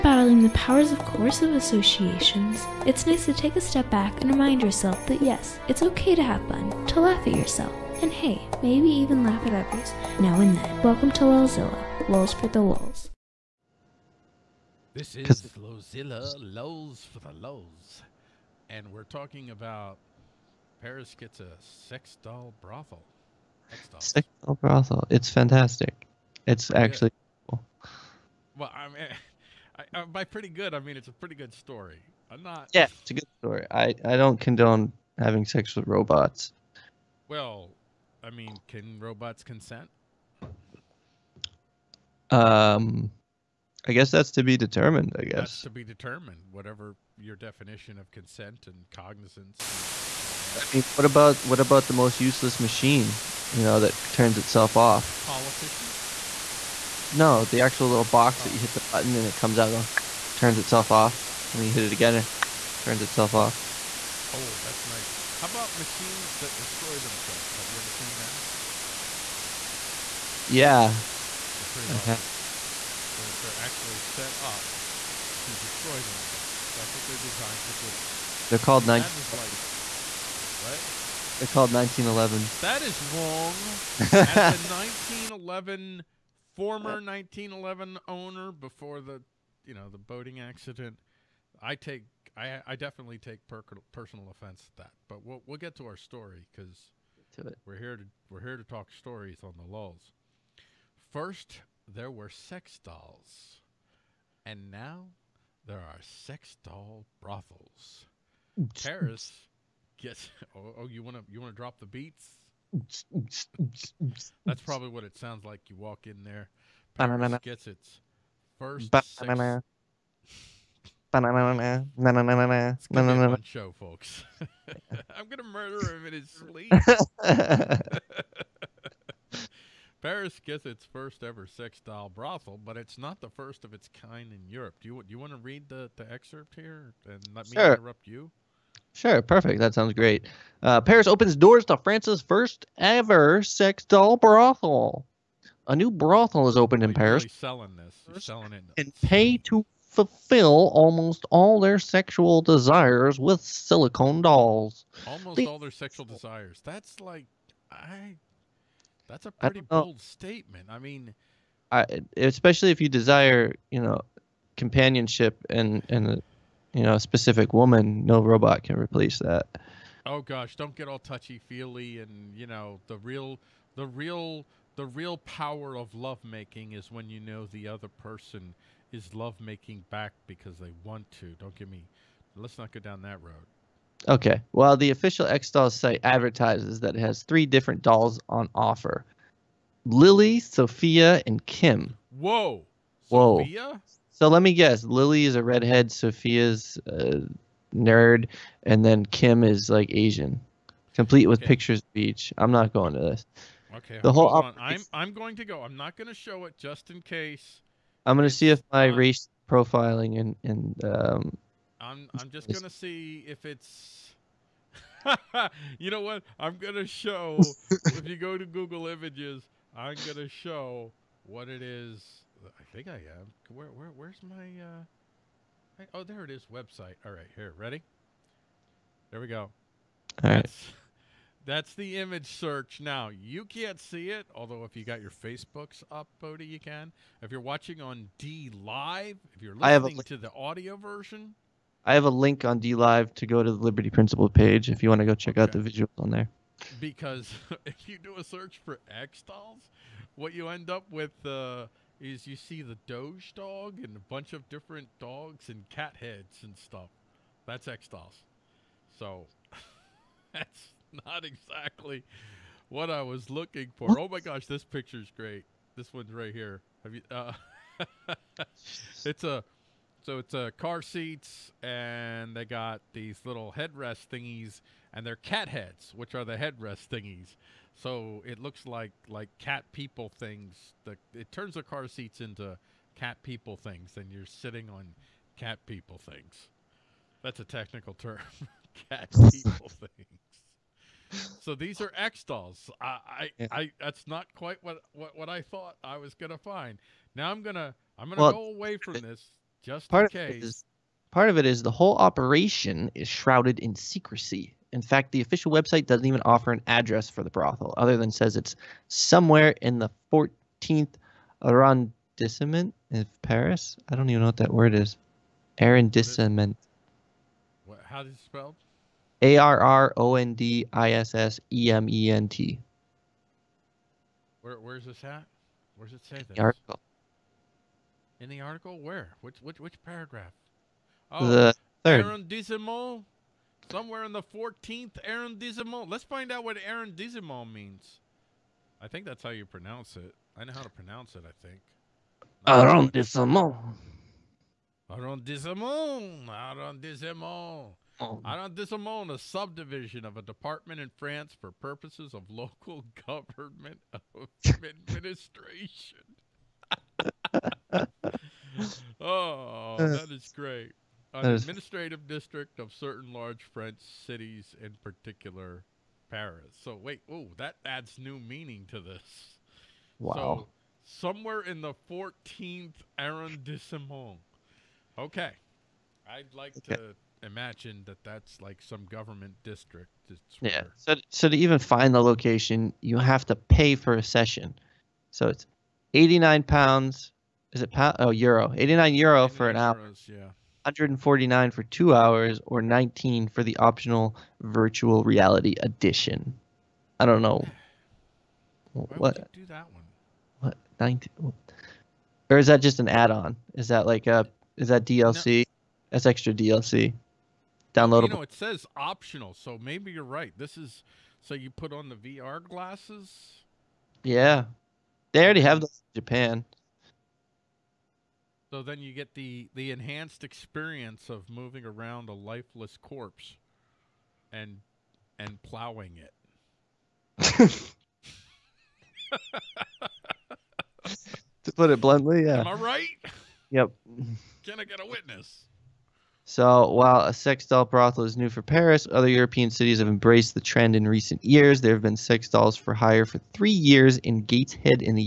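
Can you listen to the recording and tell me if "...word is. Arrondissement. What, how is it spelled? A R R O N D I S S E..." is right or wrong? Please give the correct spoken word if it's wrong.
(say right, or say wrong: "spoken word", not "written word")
right.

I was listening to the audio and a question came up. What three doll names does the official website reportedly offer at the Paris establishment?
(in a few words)
Lily, Sophia, and Kim.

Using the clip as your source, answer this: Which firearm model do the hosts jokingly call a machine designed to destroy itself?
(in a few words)
1911.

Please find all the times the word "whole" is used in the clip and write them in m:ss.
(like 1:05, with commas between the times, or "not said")
3:24, 5:01.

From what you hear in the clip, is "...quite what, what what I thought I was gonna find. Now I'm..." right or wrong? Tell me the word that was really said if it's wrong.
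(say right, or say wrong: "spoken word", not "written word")
right.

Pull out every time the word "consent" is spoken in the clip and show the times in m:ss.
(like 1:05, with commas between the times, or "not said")
0:39, 0:48.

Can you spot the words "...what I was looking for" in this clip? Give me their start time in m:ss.
4:22.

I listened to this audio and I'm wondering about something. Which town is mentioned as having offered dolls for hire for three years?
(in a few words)
Gateshead.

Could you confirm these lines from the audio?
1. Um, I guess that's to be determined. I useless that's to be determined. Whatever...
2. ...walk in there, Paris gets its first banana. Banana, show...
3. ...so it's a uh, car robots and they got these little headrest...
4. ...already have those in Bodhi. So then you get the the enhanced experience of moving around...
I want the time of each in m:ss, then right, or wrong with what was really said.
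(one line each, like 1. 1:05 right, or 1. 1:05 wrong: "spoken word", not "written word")
1. 0:42 wrong: "guess", not "useless"
2. 1:55 right
3. 4:30 wrong: "seats", not "robots"
4. 6:55 wrong: "Japan", not "Bodhi".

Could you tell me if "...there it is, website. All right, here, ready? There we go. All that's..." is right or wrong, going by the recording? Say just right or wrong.
right.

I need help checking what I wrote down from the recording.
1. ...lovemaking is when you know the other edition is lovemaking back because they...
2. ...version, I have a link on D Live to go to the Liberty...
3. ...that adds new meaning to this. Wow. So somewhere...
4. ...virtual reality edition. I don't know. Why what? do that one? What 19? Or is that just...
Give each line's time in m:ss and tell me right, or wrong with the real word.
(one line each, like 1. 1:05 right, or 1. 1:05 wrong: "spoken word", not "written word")
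1. 2:55 wrong: "person", not "edition"
2. 4:00 right
3. 6:07 right
4. 6:34 right.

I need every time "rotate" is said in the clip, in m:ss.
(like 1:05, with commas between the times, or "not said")
not said.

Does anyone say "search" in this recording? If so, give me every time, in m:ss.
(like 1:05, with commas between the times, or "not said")
3:52, 4:08.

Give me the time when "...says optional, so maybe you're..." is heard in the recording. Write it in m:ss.
6:48.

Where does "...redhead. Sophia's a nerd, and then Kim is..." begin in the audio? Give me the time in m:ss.
3:15.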